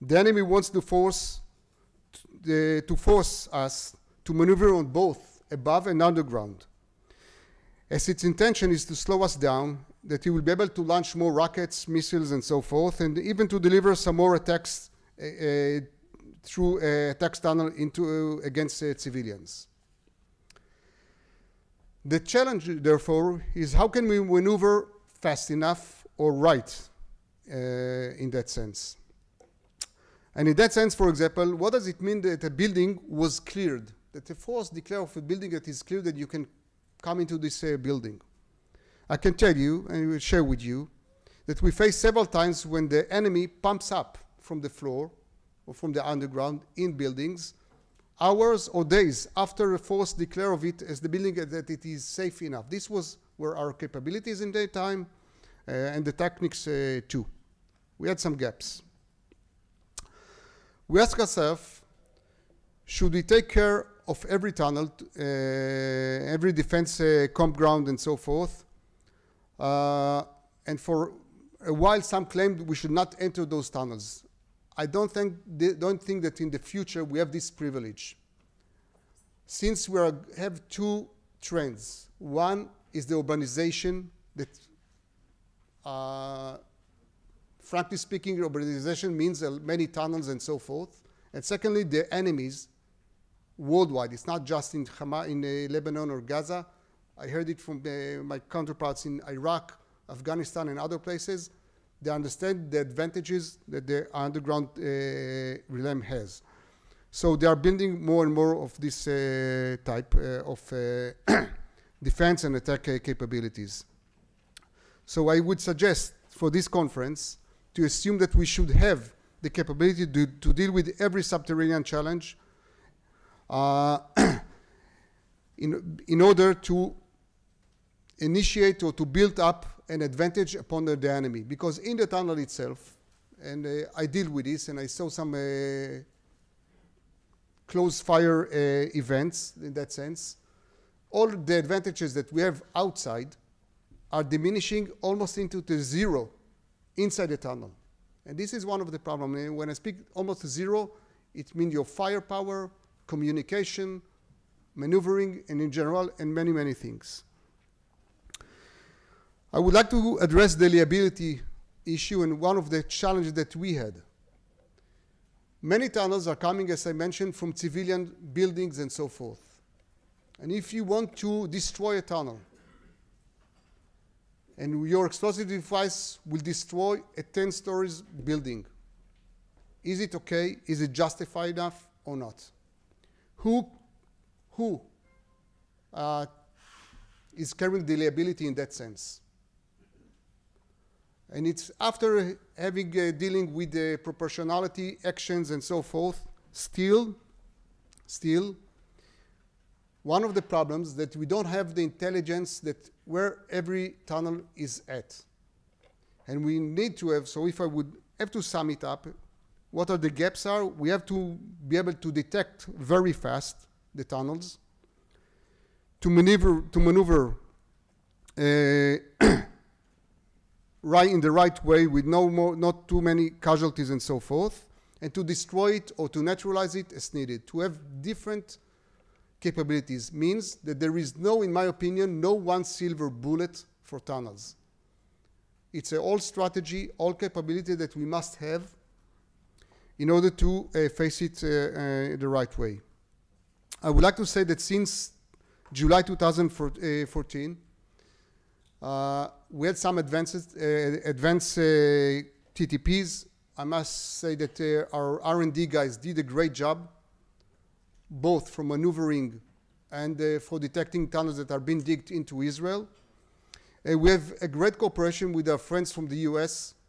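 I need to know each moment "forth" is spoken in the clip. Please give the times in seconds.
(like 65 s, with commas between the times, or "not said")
12 s, 68 s, 90 s, 169 s, 195 s, 224 s.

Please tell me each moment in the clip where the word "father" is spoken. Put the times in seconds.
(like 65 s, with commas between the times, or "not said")
not said.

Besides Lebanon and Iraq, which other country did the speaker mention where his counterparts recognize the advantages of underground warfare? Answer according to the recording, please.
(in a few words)
Afghanistan.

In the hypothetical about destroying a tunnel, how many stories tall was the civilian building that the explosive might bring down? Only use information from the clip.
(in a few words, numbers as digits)
10.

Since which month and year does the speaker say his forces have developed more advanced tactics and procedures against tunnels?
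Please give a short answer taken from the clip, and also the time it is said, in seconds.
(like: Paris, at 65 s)
July 2014, at 245 s.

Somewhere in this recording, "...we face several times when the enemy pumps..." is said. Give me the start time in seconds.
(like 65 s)
41 s.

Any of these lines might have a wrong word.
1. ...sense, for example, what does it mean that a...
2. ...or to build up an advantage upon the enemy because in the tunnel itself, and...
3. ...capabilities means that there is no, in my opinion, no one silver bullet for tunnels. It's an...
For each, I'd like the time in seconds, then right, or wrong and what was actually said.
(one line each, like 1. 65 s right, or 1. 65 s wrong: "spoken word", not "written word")
1. 30 s right
2. 128 s right
3. 229 s right.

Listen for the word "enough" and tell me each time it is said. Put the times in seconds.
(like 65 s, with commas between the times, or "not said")
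25 s, 52 s, 181 s.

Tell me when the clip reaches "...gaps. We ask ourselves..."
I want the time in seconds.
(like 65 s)
58 s.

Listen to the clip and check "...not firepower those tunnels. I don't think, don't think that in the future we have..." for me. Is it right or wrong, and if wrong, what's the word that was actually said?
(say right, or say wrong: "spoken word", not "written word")
wrong: "enter", not "firepower".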